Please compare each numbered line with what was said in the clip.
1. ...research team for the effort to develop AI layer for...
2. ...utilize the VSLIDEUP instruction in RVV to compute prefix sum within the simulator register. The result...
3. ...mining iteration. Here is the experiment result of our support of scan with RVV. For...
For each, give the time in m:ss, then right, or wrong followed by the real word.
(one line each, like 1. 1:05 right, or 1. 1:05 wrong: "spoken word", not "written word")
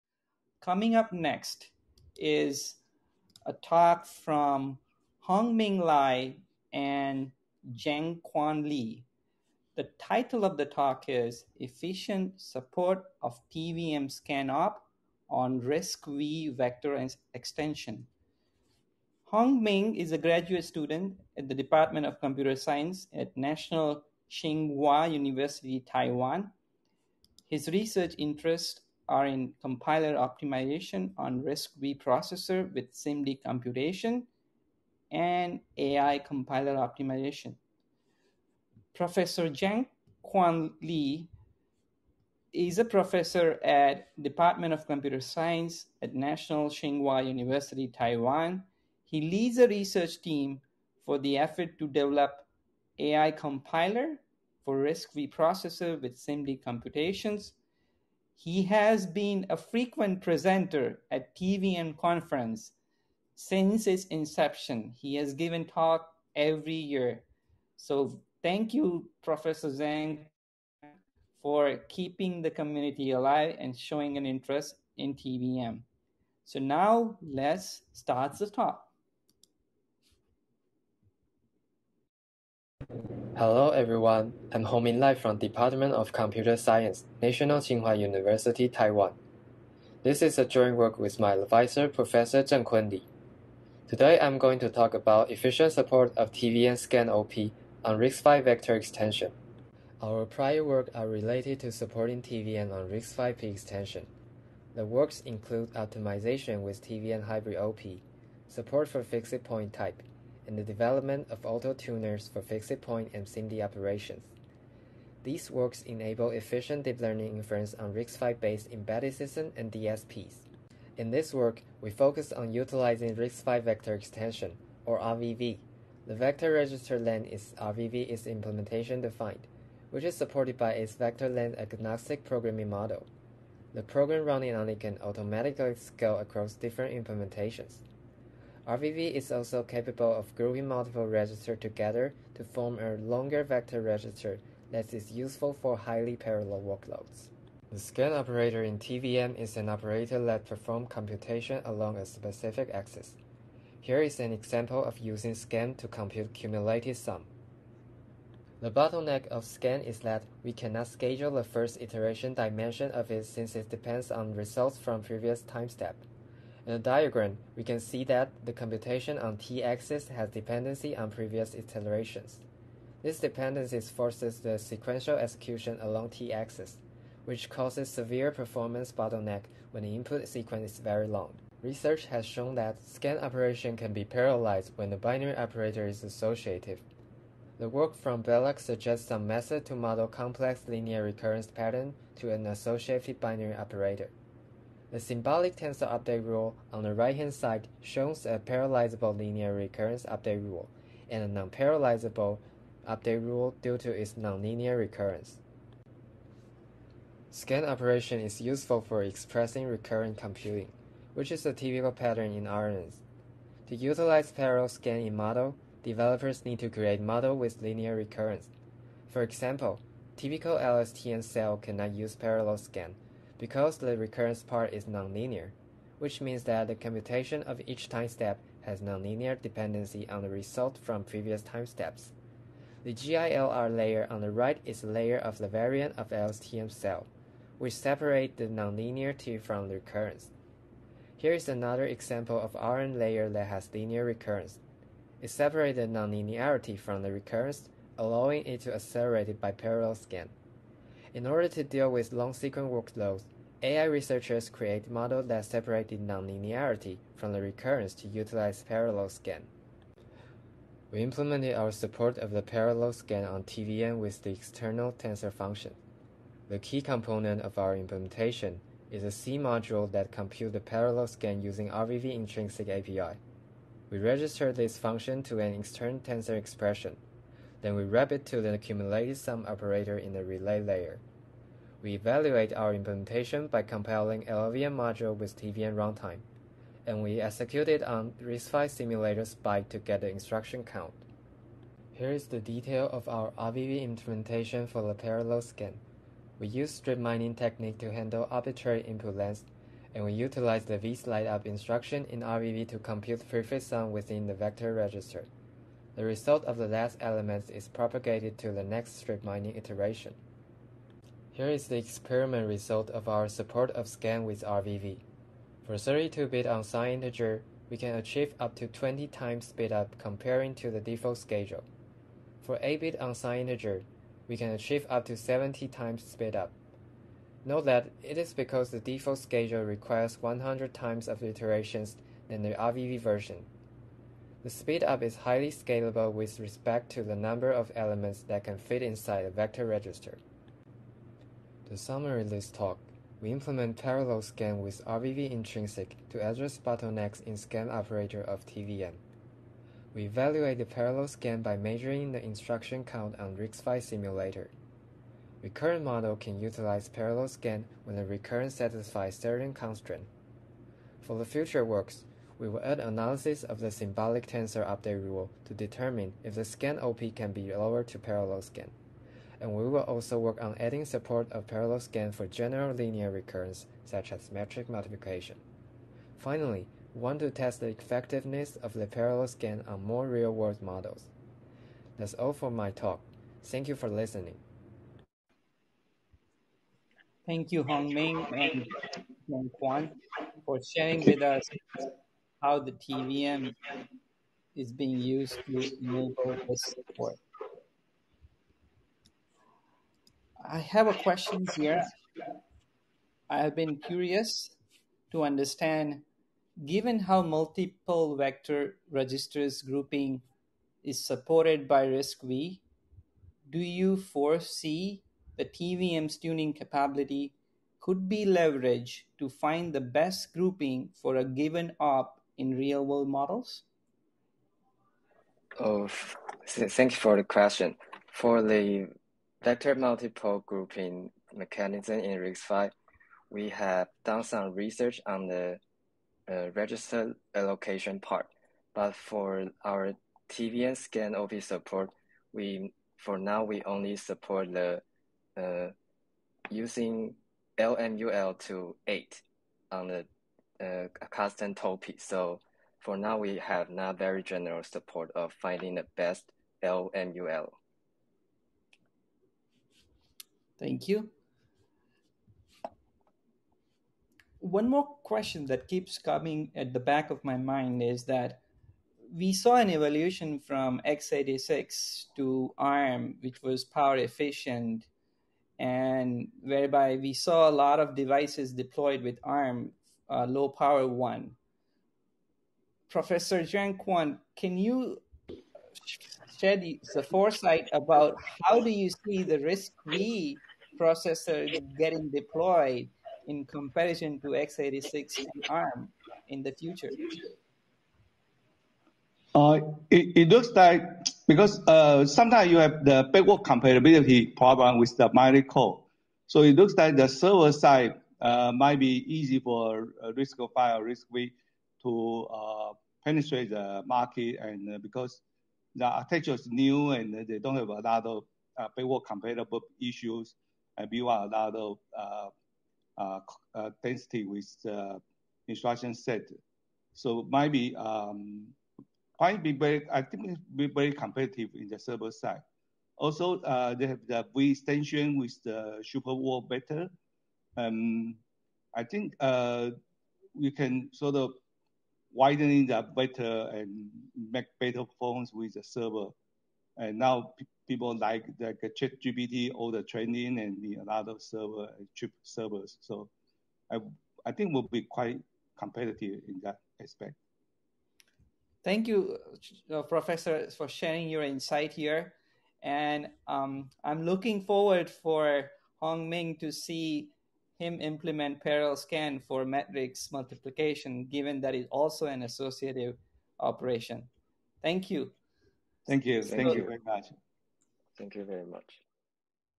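1. 0:49 wrong: "compiler", not "layer"
2. 5:00 wrong: "vector", not "simulator"
3. 5:09 right.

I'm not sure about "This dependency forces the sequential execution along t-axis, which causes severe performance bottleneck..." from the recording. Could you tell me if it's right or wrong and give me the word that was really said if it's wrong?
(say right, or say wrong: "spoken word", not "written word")
right.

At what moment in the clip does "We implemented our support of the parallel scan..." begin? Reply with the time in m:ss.
4:20.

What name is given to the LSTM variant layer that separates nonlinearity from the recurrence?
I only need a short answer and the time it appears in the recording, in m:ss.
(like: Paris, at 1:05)
GILR, at 3:52.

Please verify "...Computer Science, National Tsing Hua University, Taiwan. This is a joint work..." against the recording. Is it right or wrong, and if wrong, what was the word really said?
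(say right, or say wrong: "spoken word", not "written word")
right.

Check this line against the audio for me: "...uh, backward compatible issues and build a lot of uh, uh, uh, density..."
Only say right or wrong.
right.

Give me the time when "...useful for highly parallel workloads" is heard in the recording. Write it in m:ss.
2:25.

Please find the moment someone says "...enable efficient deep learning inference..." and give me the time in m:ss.
1:55.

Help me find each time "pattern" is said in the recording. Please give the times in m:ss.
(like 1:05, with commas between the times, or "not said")
3:11, 3:31.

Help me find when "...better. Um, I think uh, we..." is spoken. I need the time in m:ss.
8:56.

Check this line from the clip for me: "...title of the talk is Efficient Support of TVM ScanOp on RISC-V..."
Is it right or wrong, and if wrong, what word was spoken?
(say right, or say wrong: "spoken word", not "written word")
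right.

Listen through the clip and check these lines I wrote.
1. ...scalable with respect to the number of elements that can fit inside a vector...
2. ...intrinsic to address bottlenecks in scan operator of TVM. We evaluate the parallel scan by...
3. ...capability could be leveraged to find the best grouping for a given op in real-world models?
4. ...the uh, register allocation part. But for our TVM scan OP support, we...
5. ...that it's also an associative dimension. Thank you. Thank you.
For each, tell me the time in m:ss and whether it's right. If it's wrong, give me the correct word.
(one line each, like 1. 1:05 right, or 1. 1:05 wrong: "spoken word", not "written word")
1. 5:35 right
2. 5:45 right
3. 6:56 right
4. 7:15 right
5. 9:31 wrong: "operation", not "dimension".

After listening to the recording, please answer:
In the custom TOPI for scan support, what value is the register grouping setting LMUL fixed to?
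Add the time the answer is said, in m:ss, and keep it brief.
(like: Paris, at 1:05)
8, at 7:28.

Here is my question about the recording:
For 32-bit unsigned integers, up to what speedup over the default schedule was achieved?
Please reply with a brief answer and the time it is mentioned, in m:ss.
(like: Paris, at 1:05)
20 times, at 5:18.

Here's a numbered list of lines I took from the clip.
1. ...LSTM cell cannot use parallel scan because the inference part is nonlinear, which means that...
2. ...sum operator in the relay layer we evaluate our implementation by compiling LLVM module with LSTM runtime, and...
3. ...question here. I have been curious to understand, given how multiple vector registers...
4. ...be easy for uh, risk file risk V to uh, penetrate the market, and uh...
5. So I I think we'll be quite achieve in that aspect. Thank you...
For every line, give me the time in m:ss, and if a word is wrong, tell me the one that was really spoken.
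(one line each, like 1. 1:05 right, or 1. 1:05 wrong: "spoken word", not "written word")
1. 3:40 wrong: "recurrence", not "inference"
2. 4:39 wrong: "TVM", not "LSTM"
3. 6:40 right
4. 8:28 right
5. 9:12 wrong: "competitive", not "achieve".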